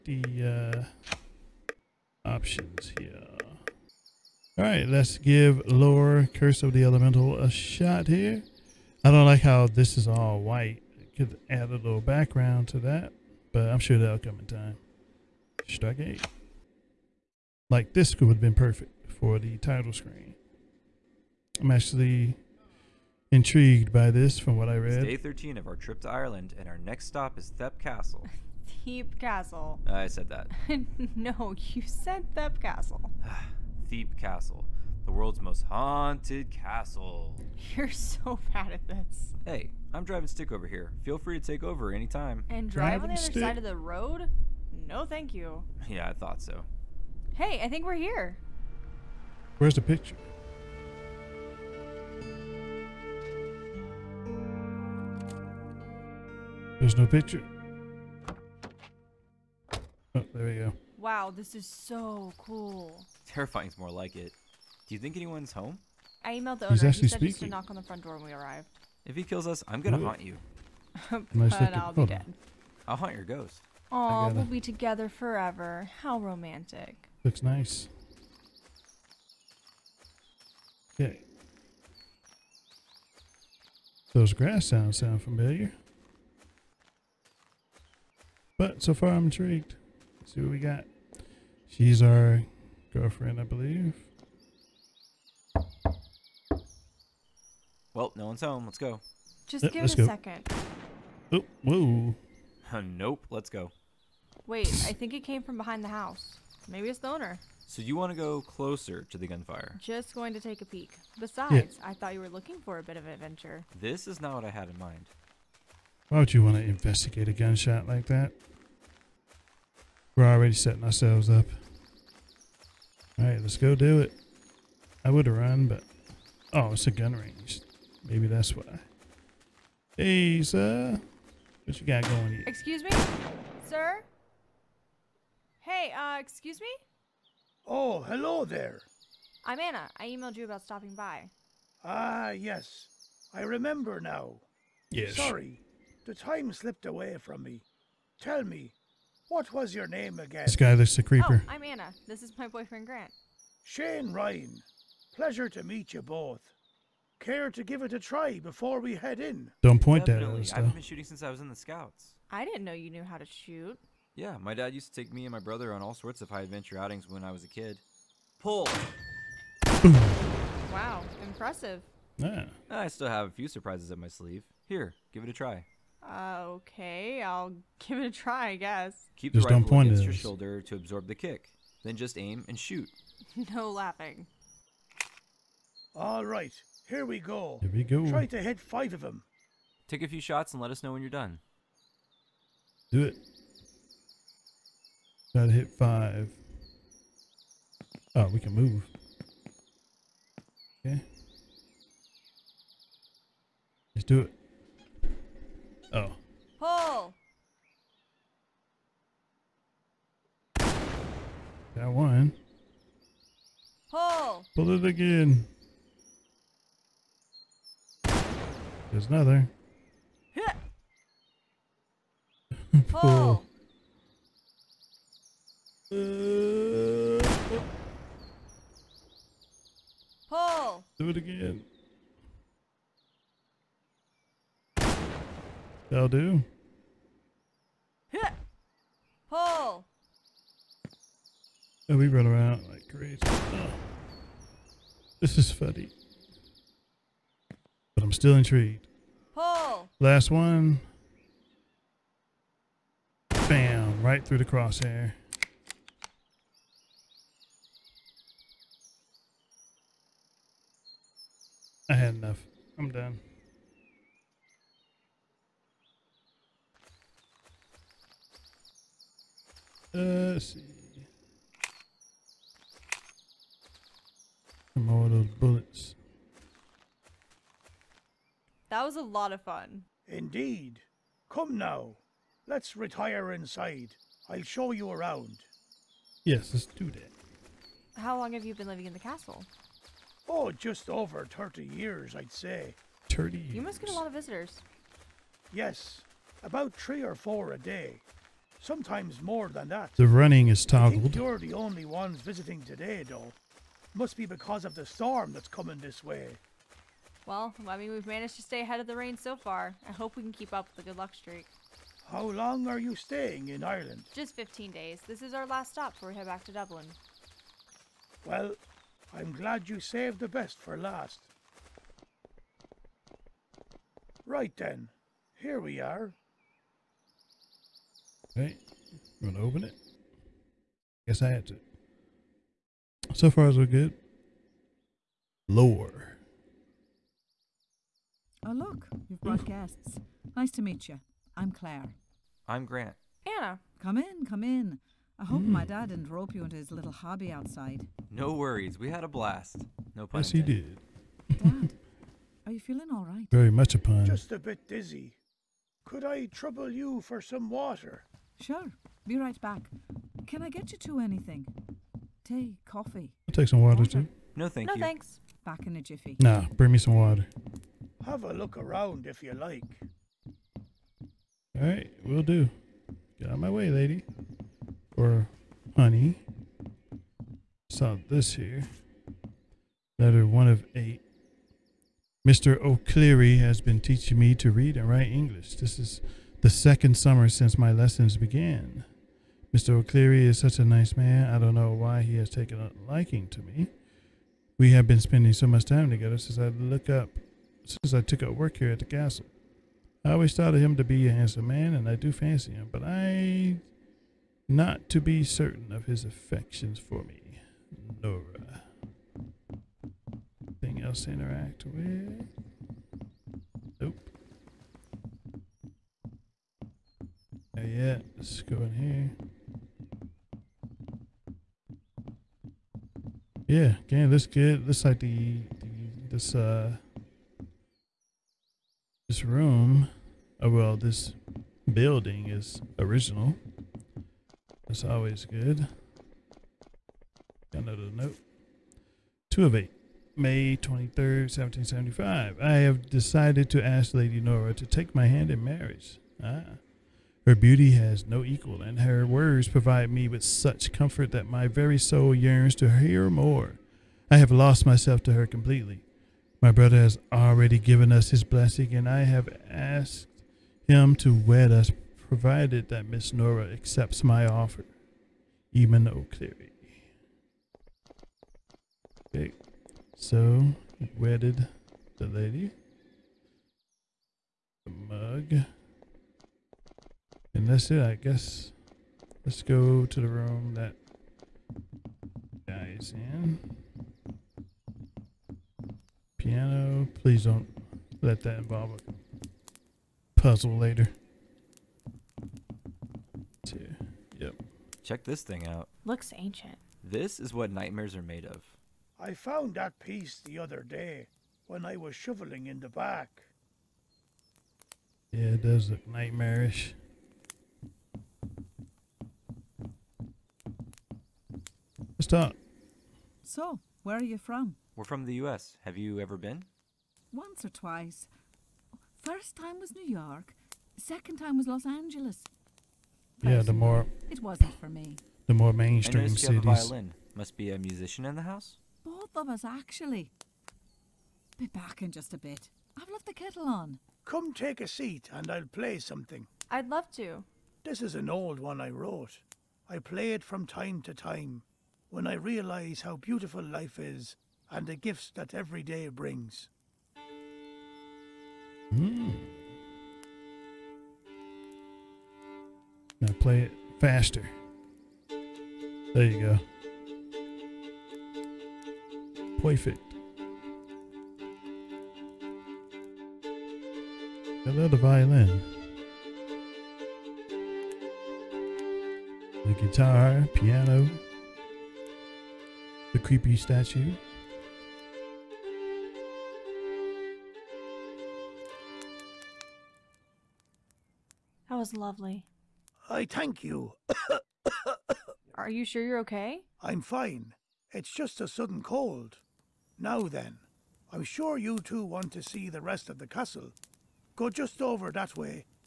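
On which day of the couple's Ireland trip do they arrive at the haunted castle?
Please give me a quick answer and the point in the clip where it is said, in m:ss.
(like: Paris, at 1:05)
13, at 0:25.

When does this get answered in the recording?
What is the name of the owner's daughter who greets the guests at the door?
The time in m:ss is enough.
5:41.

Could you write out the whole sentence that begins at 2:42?
I didn't know you knew how to shoot.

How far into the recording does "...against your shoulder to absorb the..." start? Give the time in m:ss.
2:59.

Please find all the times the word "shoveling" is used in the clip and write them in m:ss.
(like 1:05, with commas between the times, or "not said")
8:21.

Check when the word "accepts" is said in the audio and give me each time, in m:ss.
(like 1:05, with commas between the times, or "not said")
7:43.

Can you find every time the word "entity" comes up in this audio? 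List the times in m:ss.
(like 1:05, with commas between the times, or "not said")
not said.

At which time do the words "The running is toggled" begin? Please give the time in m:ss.
4:59.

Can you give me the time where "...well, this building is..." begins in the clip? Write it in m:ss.
7:10.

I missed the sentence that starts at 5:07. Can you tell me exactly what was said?
Well, I mean, we've managed to stay ahead of the rain so far.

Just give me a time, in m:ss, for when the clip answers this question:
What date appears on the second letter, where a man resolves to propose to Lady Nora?
7:20.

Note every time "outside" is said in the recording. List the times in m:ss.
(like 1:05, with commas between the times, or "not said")
5:47.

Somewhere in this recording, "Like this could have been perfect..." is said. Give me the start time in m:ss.
0:17.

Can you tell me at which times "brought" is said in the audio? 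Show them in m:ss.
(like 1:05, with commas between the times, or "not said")
5:39.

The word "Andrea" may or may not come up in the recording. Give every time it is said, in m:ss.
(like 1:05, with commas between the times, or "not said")
not said.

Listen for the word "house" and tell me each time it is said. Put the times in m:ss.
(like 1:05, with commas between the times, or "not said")
1:45, 8:48.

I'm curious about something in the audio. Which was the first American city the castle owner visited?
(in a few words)
New York.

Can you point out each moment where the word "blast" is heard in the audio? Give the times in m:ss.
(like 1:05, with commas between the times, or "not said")
5:49.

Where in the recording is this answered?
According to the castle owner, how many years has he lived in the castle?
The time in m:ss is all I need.
4:50.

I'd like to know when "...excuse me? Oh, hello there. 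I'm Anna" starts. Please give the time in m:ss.
2:16.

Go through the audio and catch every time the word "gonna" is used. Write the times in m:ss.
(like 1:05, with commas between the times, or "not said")
1:09, 5:29.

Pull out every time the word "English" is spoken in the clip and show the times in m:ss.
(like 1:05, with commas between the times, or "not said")
6:25.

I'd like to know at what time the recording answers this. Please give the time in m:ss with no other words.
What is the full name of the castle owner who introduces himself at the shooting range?
2:33.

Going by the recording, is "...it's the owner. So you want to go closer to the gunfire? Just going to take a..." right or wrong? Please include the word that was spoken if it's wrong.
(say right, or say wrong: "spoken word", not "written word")
right.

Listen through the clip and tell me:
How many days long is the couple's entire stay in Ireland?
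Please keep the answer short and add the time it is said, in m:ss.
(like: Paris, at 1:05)
15, at 5:14.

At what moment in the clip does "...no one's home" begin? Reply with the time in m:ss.
1:38.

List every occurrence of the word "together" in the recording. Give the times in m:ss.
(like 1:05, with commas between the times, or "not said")
1:14, 6:35.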